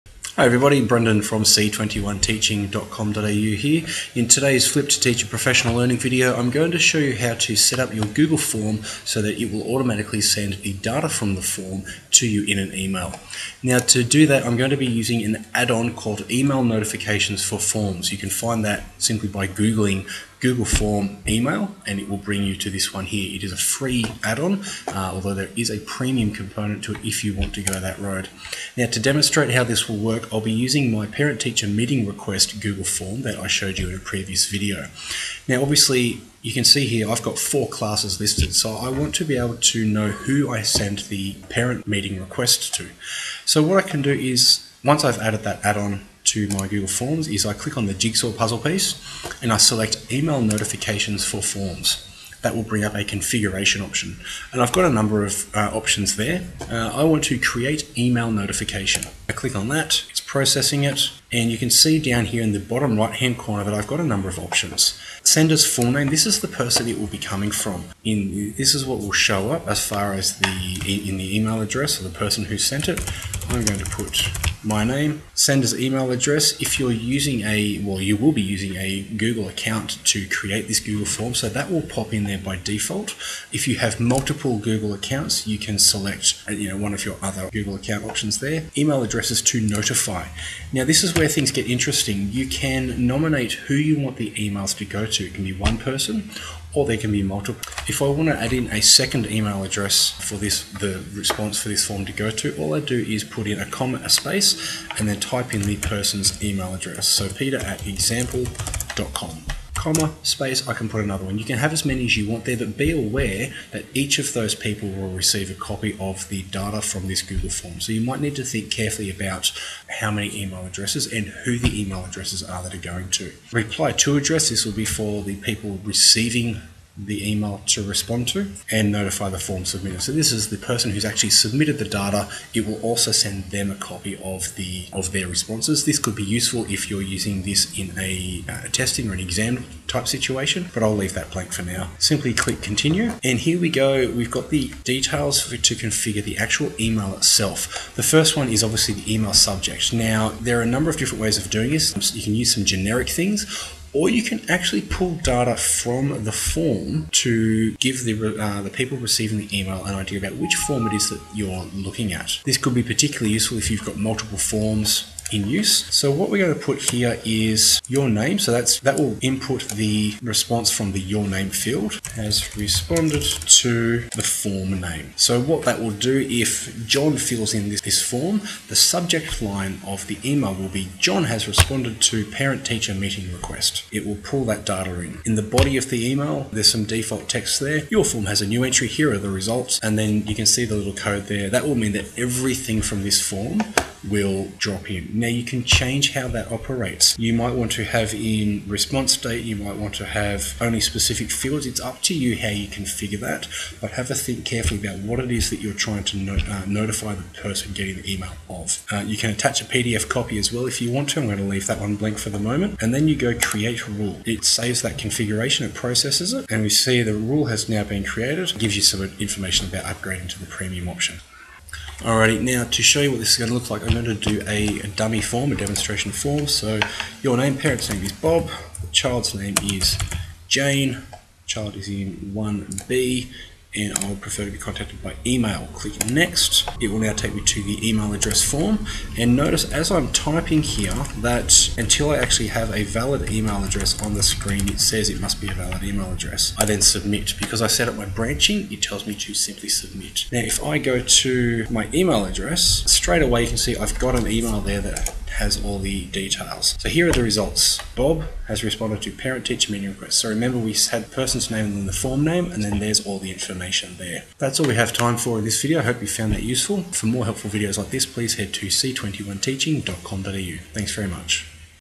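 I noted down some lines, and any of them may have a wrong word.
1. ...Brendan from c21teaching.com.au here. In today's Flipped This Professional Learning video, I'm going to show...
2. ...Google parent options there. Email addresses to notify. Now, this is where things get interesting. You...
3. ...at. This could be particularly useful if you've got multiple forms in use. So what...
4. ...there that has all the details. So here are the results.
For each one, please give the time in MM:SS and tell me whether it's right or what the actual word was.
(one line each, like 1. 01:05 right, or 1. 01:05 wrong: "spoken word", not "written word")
1. 00:00 wrong: "Teacher", not "This"
2. 01:27 wrong: "account", not "parent"
3. 02:42 right
4. 04:14 right.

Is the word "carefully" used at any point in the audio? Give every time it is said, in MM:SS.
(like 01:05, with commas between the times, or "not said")
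01:58, 03:24.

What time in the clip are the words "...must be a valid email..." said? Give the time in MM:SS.
04:05.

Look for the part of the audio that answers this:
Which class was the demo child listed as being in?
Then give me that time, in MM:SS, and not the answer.
03:52.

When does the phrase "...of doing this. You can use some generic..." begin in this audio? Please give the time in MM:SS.
02:31.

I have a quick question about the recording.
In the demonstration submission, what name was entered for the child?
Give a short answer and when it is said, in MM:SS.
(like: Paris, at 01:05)
Jane, at 03:50.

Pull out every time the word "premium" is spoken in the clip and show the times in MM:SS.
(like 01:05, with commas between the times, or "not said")
00:25, 03:40.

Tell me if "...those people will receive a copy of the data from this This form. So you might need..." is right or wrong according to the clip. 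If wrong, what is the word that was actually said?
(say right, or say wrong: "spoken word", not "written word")
wrong: "Google", not "This".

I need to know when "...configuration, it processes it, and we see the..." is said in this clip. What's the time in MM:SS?
03:34.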